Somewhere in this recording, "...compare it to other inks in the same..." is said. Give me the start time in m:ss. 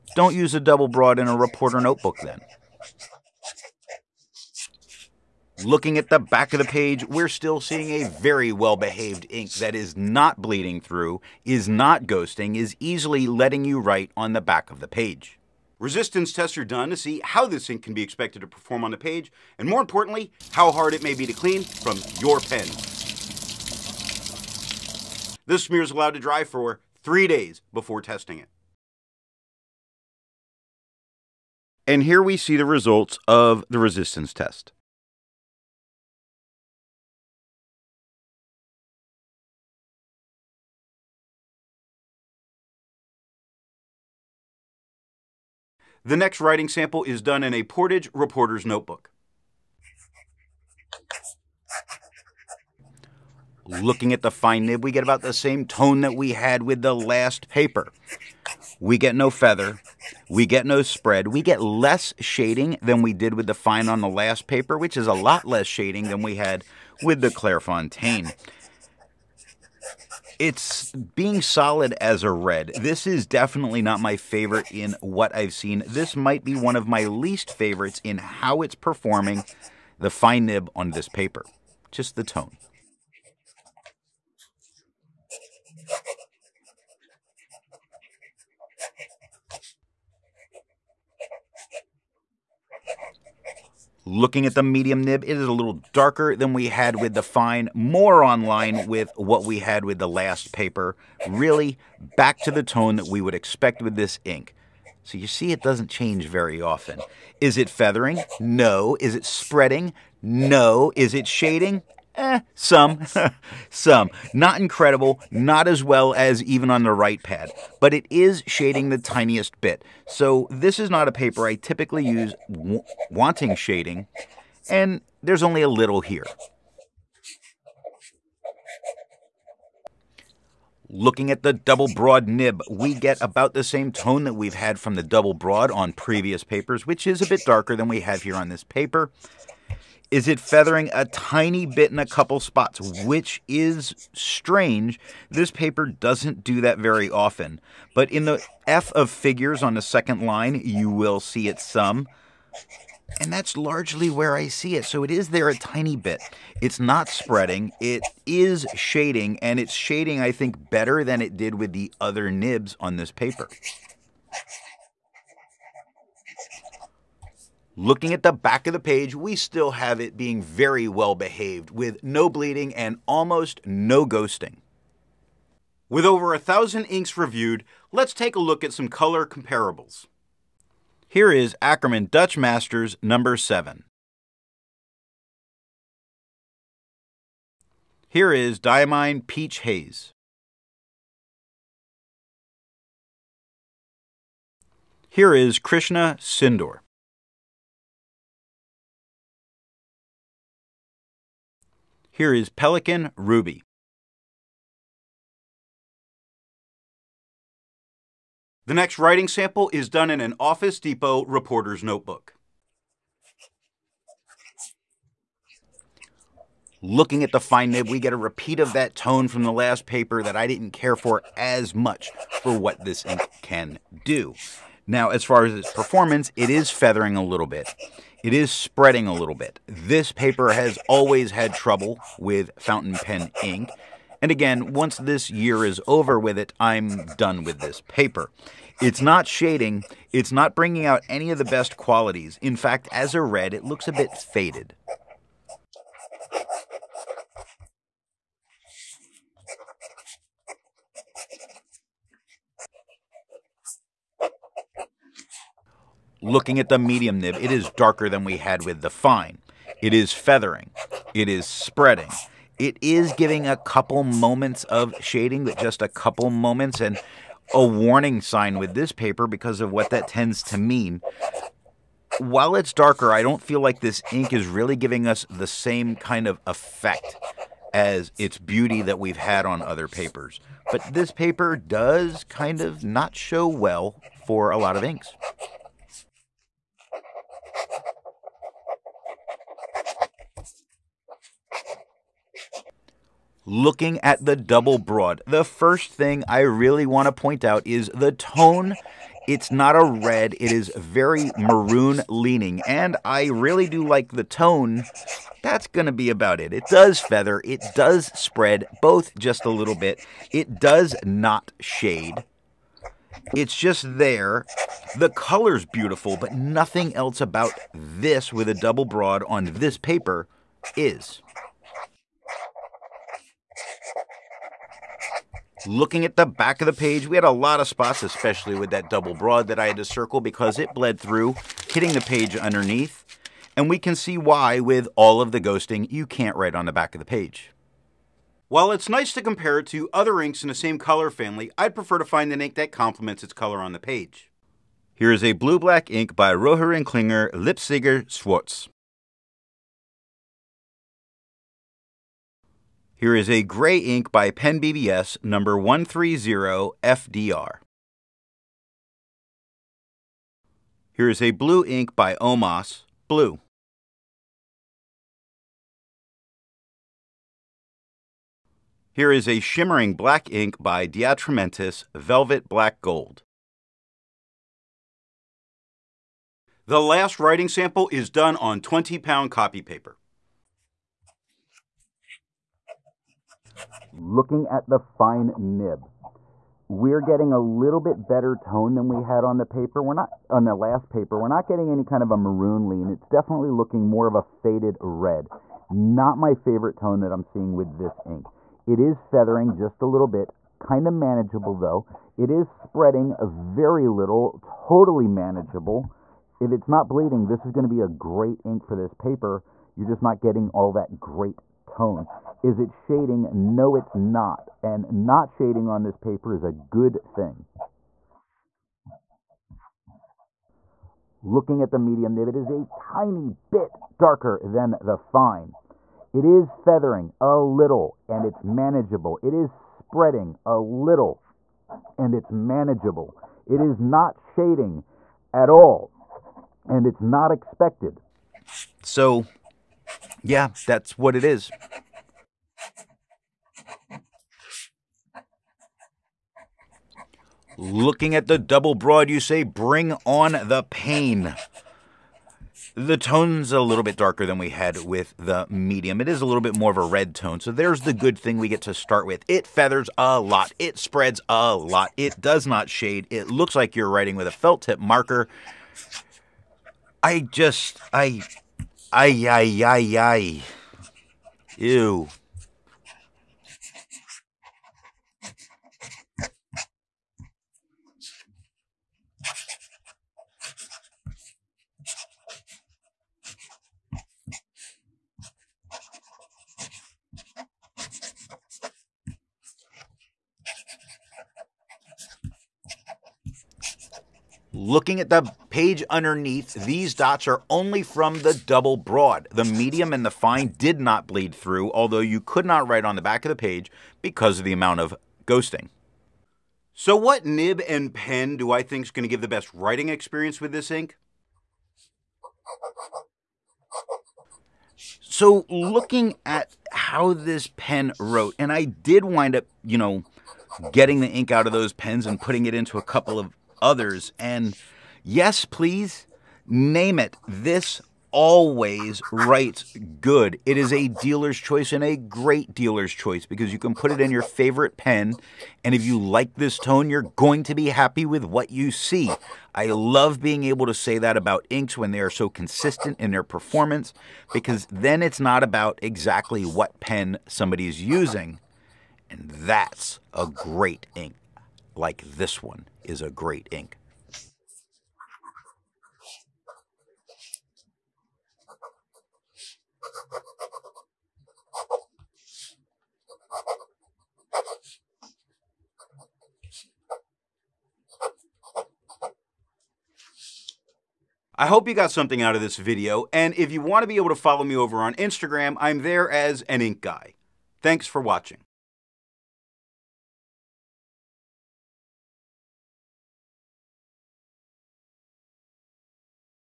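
5:39.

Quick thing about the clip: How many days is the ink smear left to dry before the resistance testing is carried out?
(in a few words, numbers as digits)
3.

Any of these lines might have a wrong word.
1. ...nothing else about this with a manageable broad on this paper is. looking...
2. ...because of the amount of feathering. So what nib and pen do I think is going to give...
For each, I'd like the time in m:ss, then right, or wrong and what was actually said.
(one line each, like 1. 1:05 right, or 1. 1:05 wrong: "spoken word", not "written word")
1. 5:16 wrong: "double", not "manageable"
2. 8:24 wrong: "ghosting", not "feathering".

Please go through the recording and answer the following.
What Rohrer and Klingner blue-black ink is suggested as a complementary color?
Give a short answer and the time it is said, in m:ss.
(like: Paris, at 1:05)
Leipziger Schwarz, at 5:47.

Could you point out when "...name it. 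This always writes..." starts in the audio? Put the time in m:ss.
8:46.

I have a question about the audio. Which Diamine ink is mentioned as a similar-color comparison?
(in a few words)
Peach Haze.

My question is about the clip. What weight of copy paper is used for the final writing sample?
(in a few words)
20 pound.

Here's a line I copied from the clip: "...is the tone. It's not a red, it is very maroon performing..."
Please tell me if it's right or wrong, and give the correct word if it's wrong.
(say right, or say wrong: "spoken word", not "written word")
wrong: "leaning", not "performing".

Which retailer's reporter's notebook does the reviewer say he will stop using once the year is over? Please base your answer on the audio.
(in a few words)
Office Depot.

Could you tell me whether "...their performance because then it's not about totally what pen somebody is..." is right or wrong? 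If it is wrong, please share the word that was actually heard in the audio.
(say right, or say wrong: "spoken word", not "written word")
wrong: "exactly", not "totally".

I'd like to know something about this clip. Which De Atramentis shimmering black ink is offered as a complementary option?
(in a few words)
Velvet Black Gold.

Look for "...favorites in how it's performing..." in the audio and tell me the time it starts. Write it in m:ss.
1:17.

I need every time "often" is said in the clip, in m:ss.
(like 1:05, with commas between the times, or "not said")
1:46, 2:27.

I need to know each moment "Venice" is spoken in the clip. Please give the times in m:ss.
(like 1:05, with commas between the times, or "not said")
not said.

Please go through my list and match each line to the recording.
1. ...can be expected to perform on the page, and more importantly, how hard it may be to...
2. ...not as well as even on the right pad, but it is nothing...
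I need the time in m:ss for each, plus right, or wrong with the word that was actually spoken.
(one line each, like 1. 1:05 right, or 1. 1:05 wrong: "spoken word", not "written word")
1. 0:17 right
2. 1:55 wrong: "shading", not "nothing".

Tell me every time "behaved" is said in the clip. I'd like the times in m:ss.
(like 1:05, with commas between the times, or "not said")
0:08, 2:51.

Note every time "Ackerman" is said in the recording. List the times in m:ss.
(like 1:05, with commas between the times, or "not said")
3:01.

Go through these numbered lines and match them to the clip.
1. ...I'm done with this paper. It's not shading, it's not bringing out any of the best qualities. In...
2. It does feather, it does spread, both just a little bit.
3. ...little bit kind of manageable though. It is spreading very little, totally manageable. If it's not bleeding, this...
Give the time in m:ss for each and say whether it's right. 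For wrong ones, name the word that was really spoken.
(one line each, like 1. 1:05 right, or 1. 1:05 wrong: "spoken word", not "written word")
1. 3:56 right
2. 5:06 right
3. 6:39 right.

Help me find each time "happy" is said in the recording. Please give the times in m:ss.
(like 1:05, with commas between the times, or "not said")
8:57.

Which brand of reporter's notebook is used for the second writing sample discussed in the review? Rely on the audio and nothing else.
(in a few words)
Portage.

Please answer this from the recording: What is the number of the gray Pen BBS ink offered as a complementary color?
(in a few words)
130FDR.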